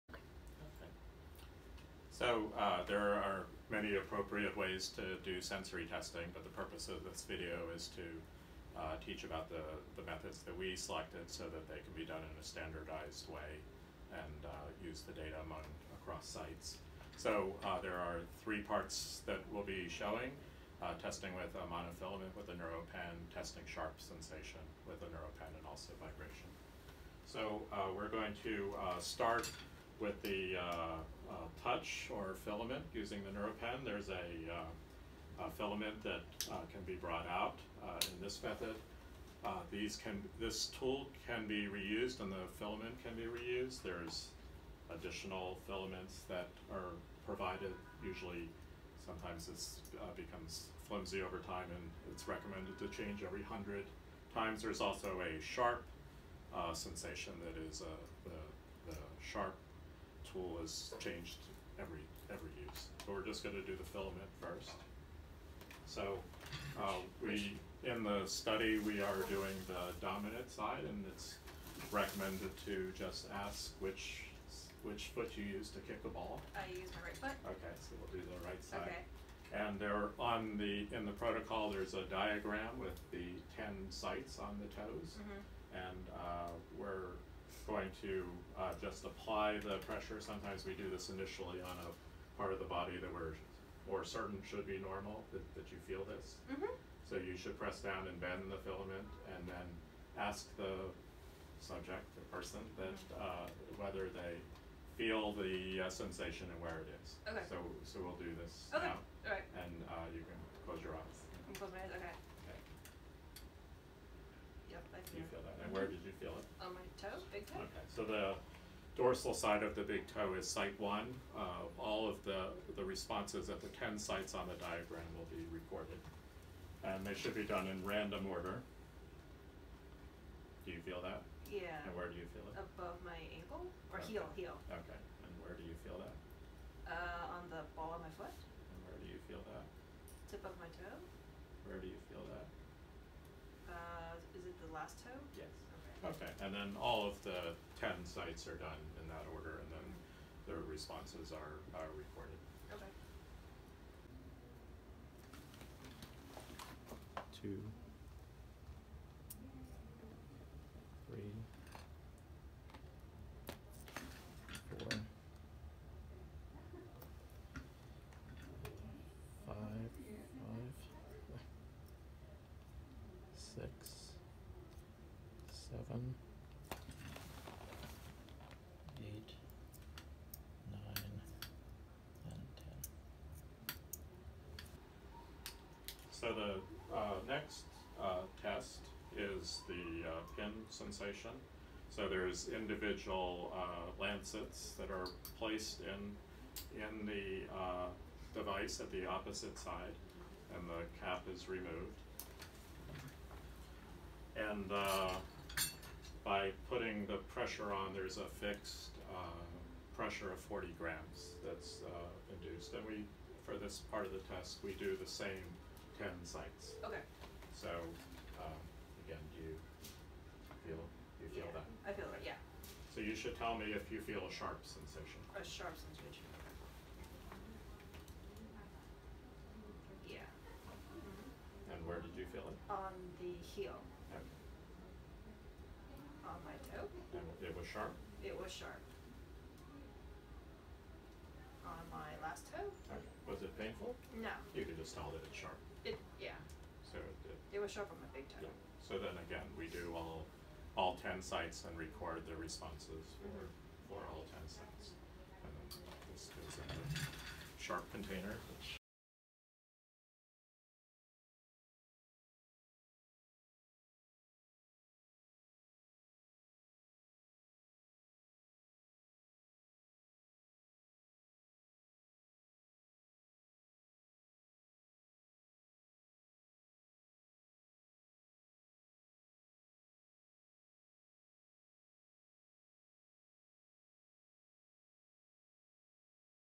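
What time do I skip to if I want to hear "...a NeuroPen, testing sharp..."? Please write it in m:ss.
0:22.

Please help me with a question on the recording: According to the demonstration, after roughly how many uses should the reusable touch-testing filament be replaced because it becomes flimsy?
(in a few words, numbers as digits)
100.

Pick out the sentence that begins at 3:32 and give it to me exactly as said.
And we, for this part of the test, we do the same 10 sites.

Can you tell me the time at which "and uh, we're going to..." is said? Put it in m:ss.
1:25.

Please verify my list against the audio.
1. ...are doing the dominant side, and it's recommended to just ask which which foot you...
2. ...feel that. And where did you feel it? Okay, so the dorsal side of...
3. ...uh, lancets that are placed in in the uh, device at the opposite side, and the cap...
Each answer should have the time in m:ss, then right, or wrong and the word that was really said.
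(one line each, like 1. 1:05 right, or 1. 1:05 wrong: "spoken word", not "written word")
1. 1:09 right
2. 1:55 right
3. 3:13 right.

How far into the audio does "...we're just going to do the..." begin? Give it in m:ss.
1:03.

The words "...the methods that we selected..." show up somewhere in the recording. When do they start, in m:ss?
0:09.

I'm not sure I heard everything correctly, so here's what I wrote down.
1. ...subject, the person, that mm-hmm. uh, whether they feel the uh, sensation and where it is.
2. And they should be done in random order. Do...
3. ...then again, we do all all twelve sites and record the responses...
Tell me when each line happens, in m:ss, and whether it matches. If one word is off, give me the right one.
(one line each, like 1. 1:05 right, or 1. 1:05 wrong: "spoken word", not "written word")
1. 1:41 right
2. 2:06 right
3. 4:08 wrong: "ten", not "twelve".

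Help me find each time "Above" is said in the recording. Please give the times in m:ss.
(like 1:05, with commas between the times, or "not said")
2:12.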